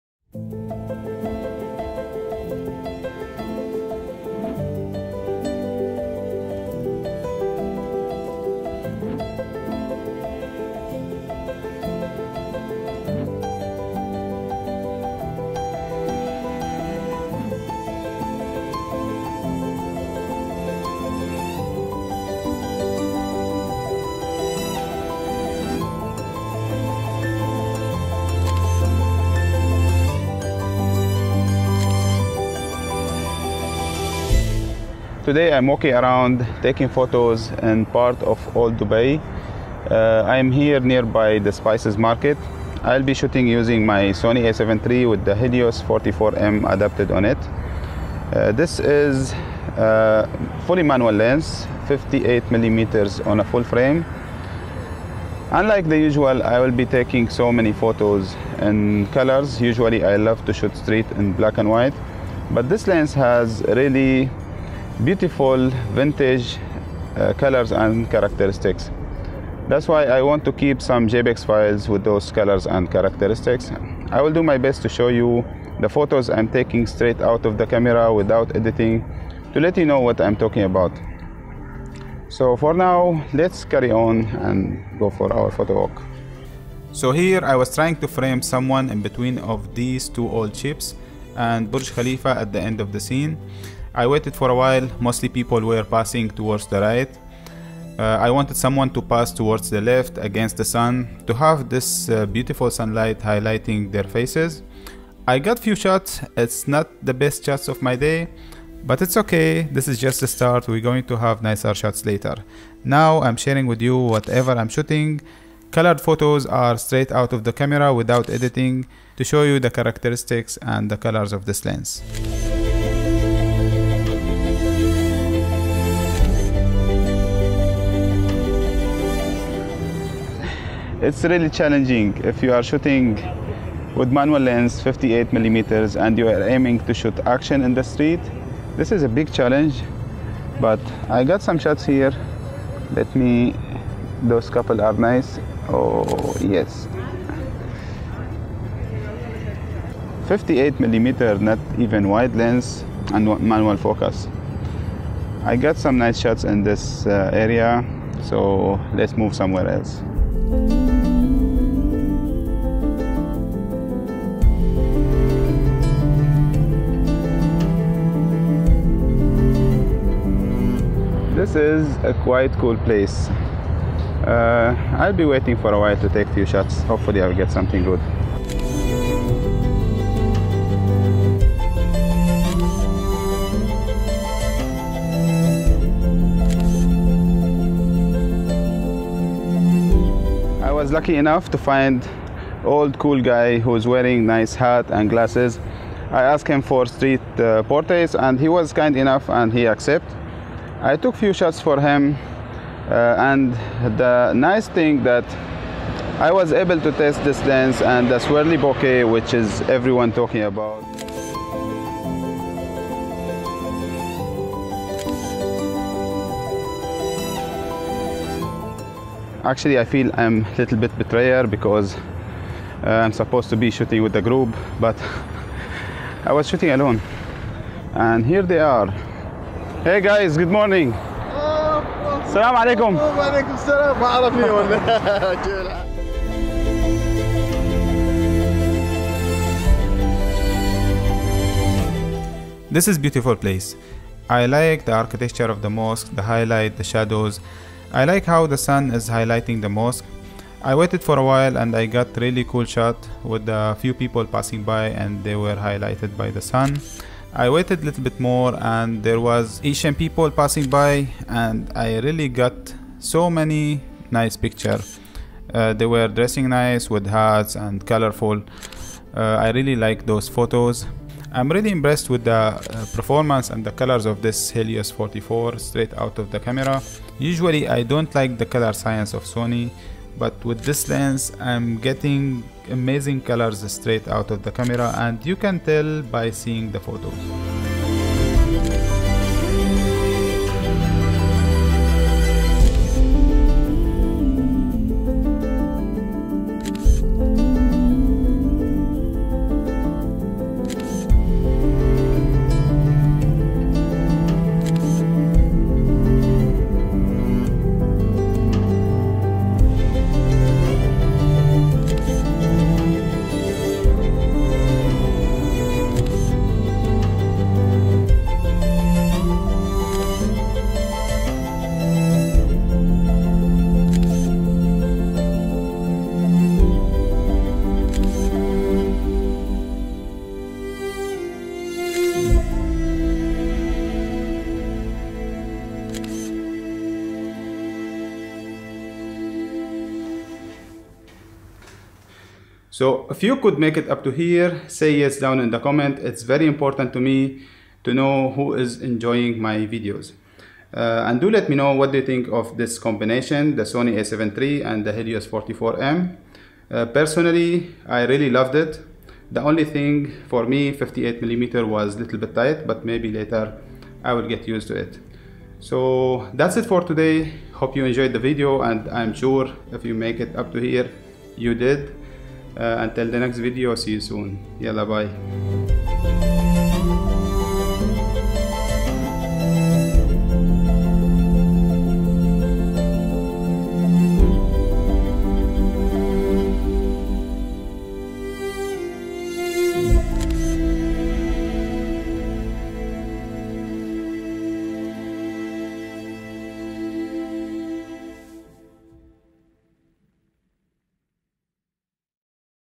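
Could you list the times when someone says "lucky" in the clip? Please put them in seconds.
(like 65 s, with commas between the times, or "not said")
190 s.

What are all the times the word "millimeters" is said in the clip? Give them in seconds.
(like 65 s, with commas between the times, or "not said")
52 s, 135 s, 150 s, 361 s.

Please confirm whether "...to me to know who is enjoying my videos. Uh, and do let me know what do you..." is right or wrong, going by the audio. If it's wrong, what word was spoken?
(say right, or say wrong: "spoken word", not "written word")
right.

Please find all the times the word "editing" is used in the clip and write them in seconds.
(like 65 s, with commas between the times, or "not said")
78 s, 118 s.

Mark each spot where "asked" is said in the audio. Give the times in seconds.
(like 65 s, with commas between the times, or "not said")
196 s.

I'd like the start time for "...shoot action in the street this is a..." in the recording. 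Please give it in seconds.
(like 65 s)
136 s.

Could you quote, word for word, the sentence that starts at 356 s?
Uh, personally, I really loved it.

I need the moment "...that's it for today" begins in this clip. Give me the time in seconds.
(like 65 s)
366 s.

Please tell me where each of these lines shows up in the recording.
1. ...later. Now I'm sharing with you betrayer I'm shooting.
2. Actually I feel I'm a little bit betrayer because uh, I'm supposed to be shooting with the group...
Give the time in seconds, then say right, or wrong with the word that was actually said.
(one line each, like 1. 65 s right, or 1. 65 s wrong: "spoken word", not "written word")
1. 112 s wrong: "whatever", not "betrayer"
2. 219 s right.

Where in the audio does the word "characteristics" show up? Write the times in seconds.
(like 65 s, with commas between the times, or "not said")
68 s, 72 s, 119 s.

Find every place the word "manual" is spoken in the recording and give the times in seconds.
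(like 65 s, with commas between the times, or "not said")
50 s, 134 s, 153 s.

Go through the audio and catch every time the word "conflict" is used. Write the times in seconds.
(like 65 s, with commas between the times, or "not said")
not said.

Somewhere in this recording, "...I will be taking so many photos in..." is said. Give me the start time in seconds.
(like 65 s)
56 s.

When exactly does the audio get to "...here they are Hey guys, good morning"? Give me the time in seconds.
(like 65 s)
228 s.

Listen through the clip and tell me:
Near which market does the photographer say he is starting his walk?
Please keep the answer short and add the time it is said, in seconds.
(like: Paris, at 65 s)
spices market, at 41 s.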